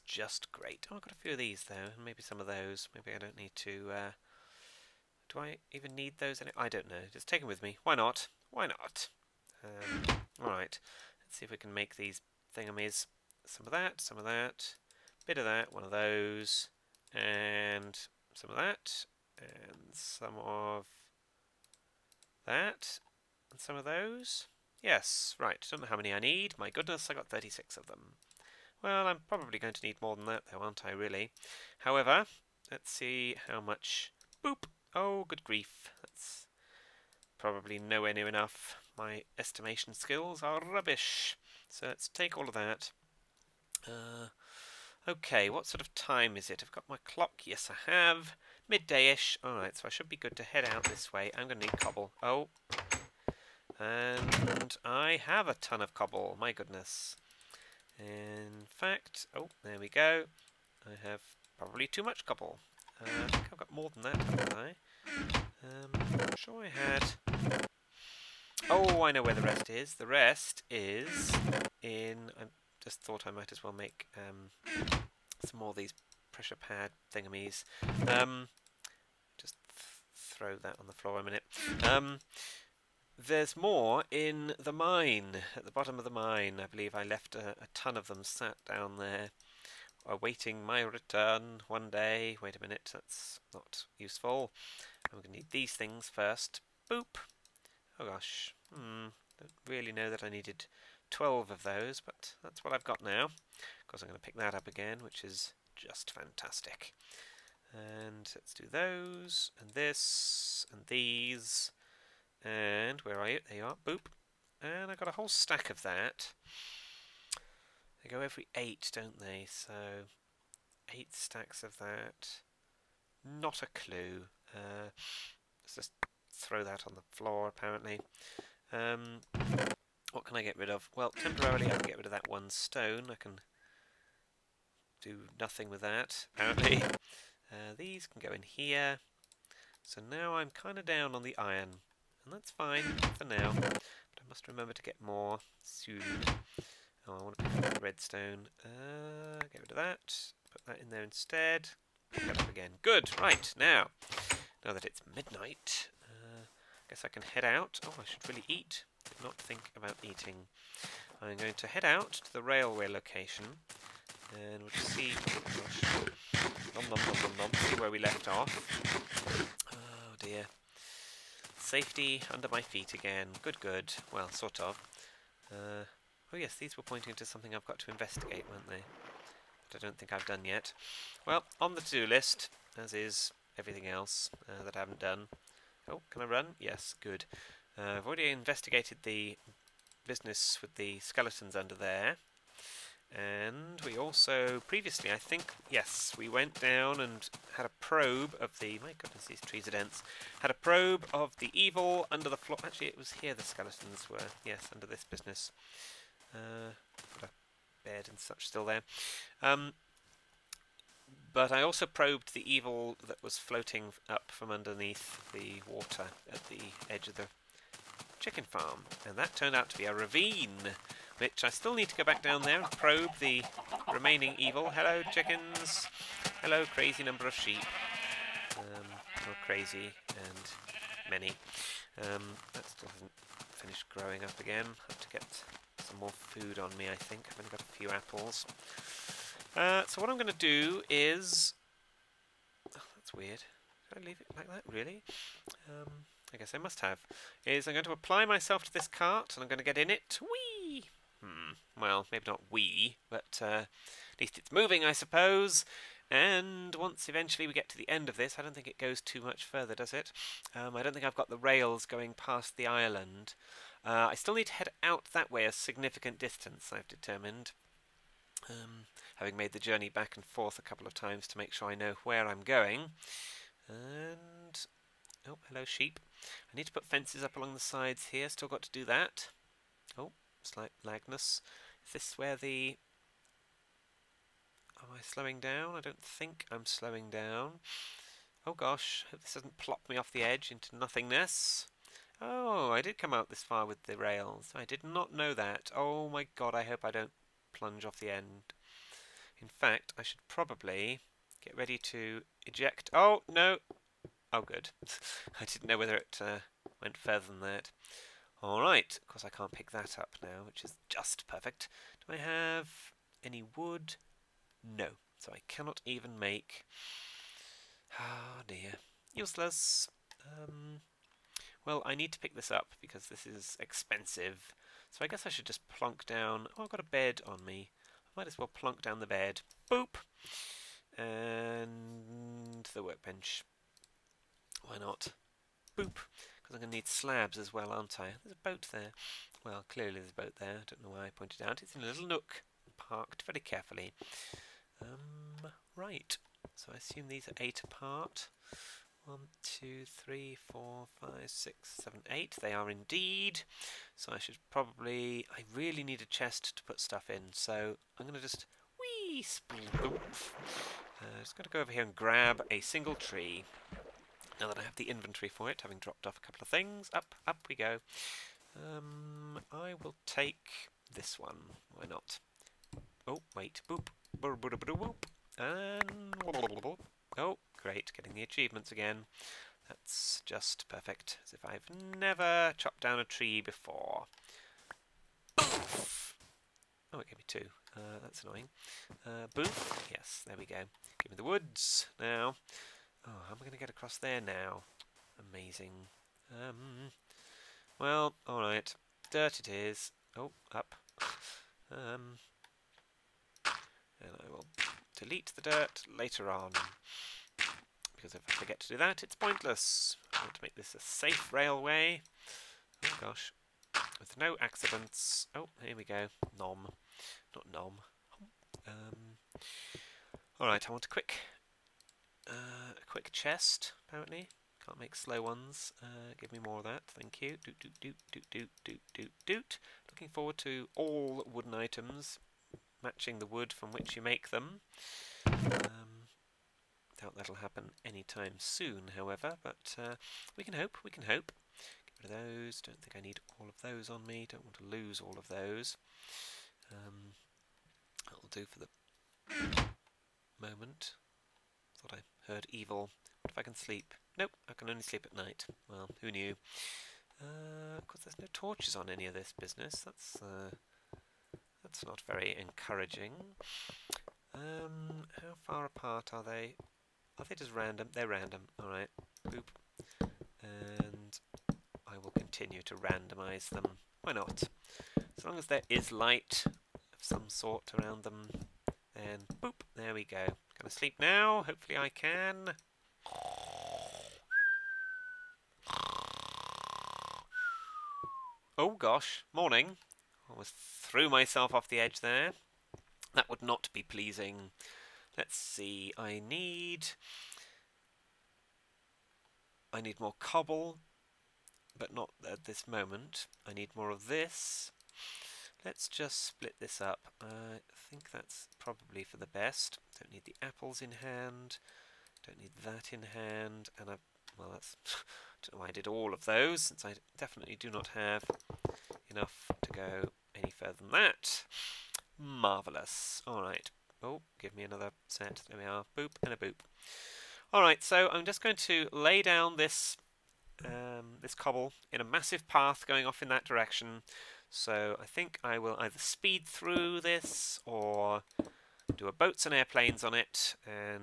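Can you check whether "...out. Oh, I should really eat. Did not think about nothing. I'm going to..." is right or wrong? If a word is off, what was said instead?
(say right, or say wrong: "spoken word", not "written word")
wrong: "eating", not "nothing".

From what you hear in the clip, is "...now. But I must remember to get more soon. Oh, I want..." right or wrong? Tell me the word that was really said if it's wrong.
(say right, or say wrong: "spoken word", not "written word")
right.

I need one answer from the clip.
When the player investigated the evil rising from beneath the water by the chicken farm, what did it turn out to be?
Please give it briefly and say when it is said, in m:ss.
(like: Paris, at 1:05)
A ravine, at 3:39.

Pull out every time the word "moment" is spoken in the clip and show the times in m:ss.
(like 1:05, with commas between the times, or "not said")
7:30, 8:22.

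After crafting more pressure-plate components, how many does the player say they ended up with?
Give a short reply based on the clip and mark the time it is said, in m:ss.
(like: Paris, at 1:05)
12, at 1:41.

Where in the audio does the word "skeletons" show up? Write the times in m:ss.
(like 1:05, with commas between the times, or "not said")
3:10, 3:23.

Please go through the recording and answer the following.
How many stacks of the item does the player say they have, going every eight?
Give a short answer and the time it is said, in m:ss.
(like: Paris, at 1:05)
8, at 2:00.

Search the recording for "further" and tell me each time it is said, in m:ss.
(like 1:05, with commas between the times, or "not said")
4:19, 5:06, 8:40.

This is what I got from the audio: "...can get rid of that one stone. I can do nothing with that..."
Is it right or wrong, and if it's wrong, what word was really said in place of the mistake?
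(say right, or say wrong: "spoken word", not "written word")
right.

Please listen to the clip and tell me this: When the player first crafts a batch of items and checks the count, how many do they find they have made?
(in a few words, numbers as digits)
36.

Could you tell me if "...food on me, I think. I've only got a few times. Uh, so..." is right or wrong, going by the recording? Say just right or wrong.
wrong.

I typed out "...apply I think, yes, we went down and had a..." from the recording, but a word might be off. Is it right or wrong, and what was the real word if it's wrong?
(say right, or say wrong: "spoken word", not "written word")
wrong: "previously", not "apply".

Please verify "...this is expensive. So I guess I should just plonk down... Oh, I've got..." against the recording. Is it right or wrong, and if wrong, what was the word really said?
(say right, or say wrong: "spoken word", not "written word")
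right.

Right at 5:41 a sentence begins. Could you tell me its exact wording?
It's in a little nook, parked very carefully.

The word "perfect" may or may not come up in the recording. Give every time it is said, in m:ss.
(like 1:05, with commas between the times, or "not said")
5:11, 6:20.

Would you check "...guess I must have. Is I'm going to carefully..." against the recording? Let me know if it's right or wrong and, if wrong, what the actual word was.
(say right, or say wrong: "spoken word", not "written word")
wrong: "apply", not "carefully".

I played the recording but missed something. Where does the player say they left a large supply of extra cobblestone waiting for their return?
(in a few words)
Bottom of the mine.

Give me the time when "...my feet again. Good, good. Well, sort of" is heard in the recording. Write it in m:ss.
2:52.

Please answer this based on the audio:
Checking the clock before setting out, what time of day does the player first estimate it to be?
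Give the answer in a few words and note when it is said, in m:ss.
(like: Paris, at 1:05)
Midday-ish, at 0:48.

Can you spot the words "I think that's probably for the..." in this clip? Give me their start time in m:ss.
8:27.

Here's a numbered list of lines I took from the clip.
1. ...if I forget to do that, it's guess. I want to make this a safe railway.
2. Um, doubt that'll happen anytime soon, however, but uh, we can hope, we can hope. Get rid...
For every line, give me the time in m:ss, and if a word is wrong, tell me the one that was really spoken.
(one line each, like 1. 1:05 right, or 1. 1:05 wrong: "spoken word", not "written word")
1. 6:48 wrong: "pointless", not "guess"
2. 7:15 right.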